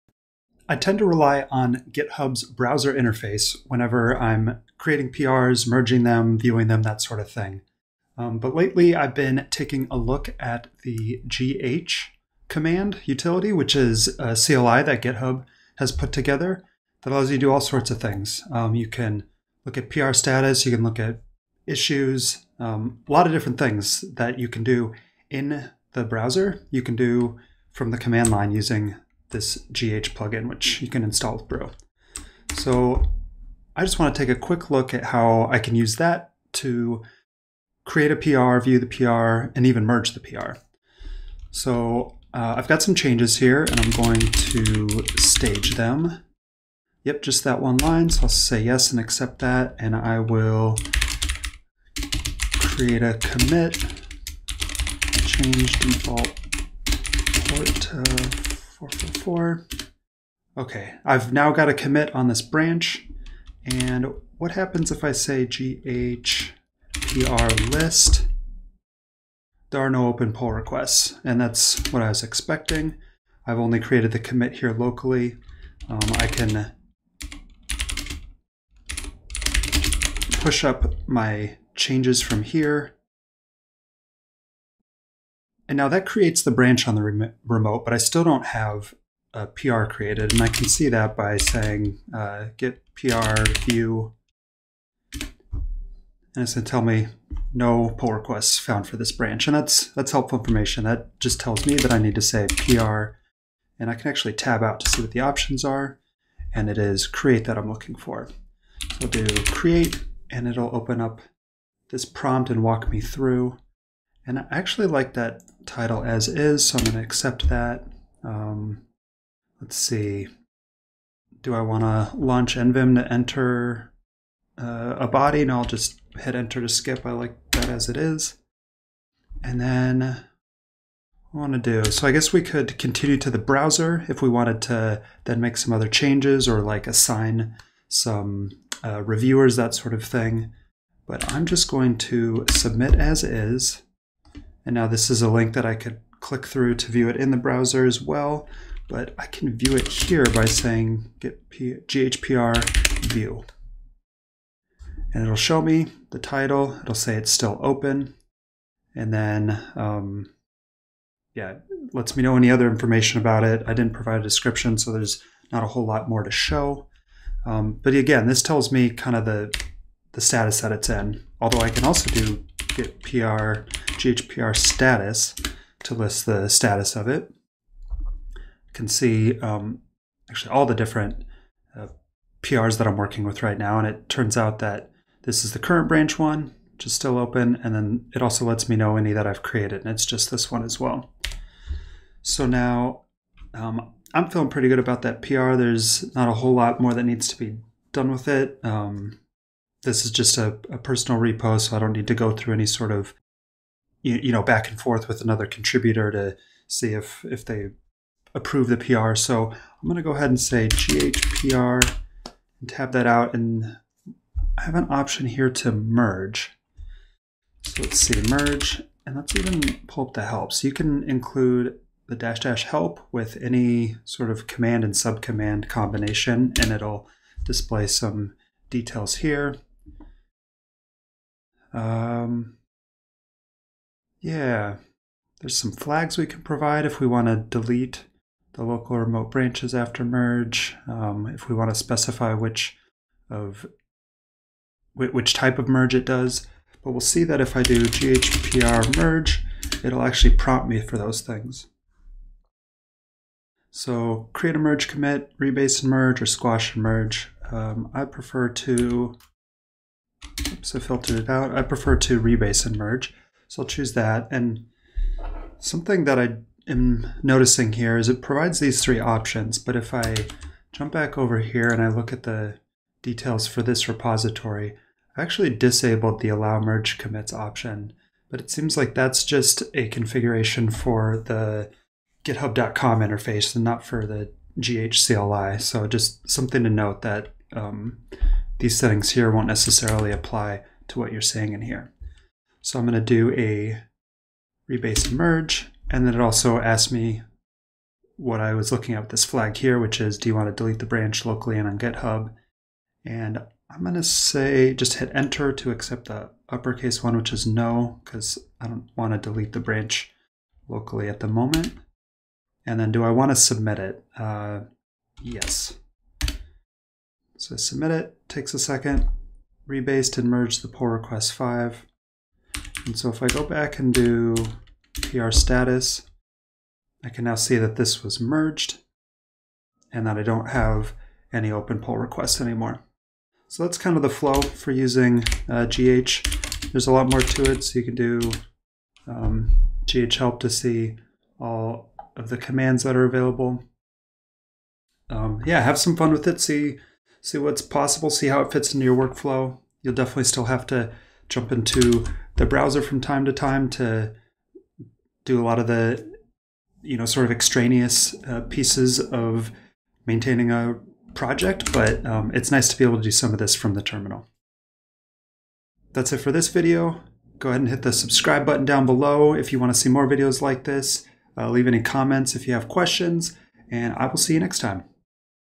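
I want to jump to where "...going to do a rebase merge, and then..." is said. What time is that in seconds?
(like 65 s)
292 s.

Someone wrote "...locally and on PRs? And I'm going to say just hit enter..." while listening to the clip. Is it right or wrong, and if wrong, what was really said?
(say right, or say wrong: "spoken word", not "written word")
wrong: "GitHub", not "PRs".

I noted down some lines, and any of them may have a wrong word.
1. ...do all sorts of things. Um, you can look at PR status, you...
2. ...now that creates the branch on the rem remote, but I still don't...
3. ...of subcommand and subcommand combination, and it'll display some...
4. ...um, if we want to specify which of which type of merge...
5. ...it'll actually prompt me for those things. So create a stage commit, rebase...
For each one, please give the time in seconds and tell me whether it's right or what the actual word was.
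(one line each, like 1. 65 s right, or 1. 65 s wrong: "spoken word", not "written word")
1. 17 s right
2. 85 s right
3. 224 s wrong: "command", not "subcommand"
4. 240 s right
5. 249 s wrong: "merge", not "stage".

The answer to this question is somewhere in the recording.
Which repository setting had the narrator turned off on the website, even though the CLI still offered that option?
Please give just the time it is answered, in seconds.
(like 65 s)
276 s.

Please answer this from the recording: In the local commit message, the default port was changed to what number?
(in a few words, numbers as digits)
444.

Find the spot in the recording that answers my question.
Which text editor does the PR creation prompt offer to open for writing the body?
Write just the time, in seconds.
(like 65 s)
122 s.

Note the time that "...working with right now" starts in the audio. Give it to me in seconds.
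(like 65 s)
182 s.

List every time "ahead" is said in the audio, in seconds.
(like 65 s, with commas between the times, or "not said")
210 s, 367 s.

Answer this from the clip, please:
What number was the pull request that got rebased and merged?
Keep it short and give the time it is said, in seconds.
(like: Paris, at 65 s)
5, at 321 s.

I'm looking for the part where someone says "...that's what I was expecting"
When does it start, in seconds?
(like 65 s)
71 s.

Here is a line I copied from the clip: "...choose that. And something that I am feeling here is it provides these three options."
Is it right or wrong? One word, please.
wrong.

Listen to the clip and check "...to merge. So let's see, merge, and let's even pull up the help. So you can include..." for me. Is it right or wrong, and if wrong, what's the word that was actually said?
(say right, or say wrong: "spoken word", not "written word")
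right.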